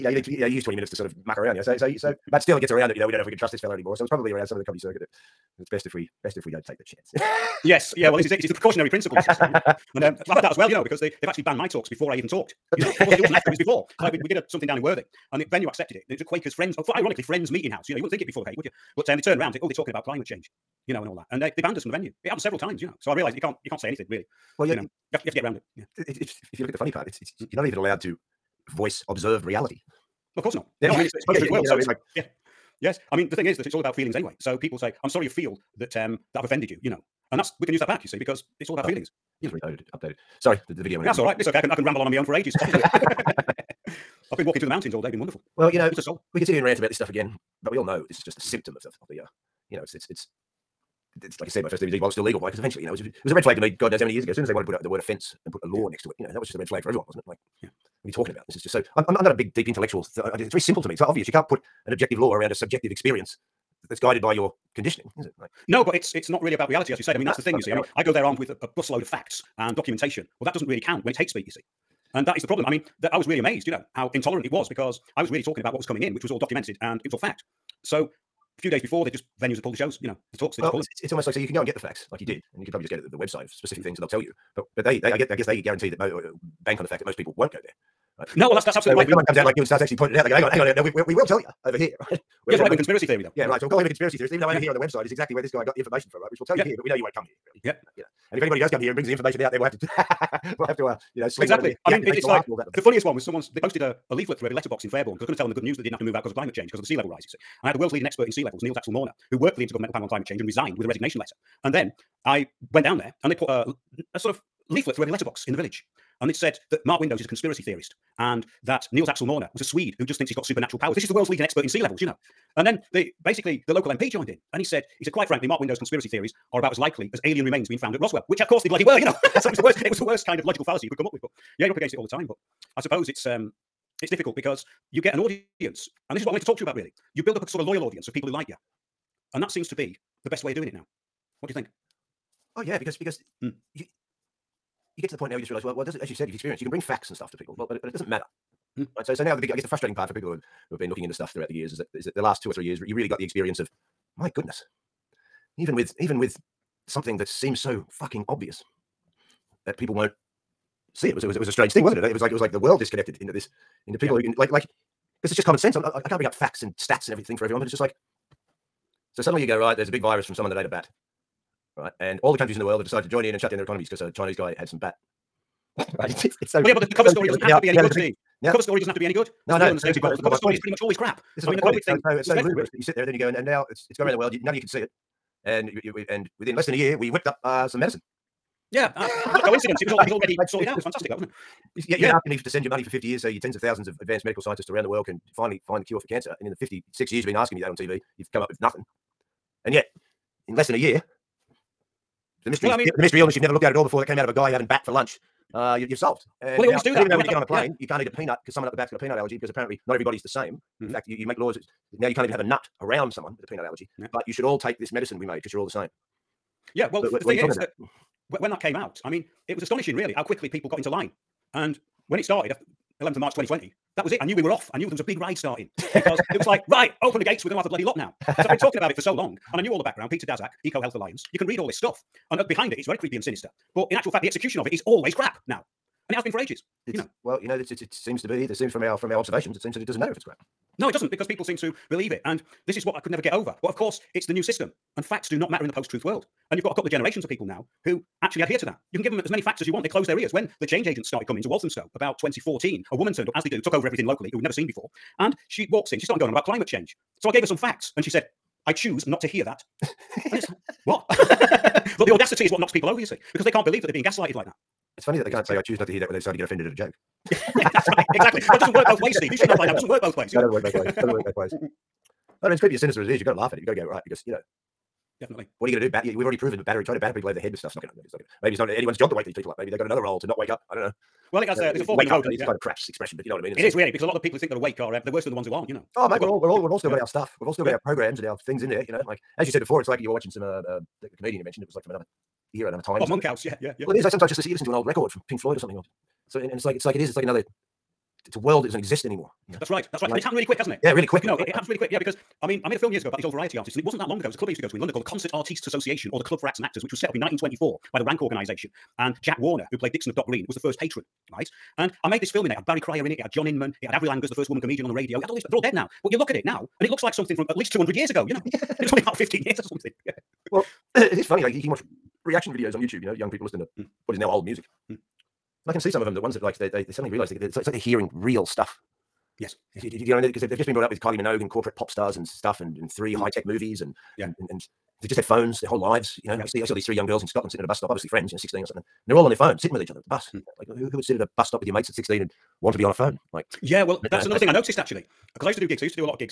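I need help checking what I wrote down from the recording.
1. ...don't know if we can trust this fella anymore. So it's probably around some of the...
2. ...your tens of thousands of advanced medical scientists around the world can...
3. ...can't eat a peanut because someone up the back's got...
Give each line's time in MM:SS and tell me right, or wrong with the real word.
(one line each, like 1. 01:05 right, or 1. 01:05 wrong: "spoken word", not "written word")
1. 00:03 right
2. 03:13 right
3. 03:27 right.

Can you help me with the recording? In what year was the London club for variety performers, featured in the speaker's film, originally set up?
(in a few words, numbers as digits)
1924.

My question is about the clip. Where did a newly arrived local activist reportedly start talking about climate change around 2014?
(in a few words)
Walthamstow.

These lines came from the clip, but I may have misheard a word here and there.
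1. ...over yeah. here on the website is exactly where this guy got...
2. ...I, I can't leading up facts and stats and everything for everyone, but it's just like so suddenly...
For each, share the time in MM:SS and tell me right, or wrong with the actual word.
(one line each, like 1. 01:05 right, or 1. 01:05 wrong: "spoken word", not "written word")
1. 01:34 right
2. 02:45 wrong: "bring", not "leading".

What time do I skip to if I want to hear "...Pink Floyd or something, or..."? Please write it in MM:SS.
04:55.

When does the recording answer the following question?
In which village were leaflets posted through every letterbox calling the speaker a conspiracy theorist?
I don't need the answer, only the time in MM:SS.
01:44.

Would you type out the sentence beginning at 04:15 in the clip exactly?
And she walks in, she's starting going on about climate change.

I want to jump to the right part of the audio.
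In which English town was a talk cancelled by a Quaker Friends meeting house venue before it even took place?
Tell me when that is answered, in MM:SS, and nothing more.
00:14.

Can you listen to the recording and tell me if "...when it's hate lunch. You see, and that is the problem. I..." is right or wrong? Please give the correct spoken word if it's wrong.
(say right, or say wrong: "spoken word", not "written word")
wrong: "speech", not "lunch".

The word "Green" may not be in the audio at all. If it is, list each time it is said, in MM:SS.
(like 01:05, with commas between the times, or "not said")
05:10.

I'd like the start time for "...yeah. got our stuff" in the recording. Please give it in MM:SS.
04:46.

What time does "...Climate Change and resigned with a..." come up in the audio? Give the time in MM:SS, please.
01:50.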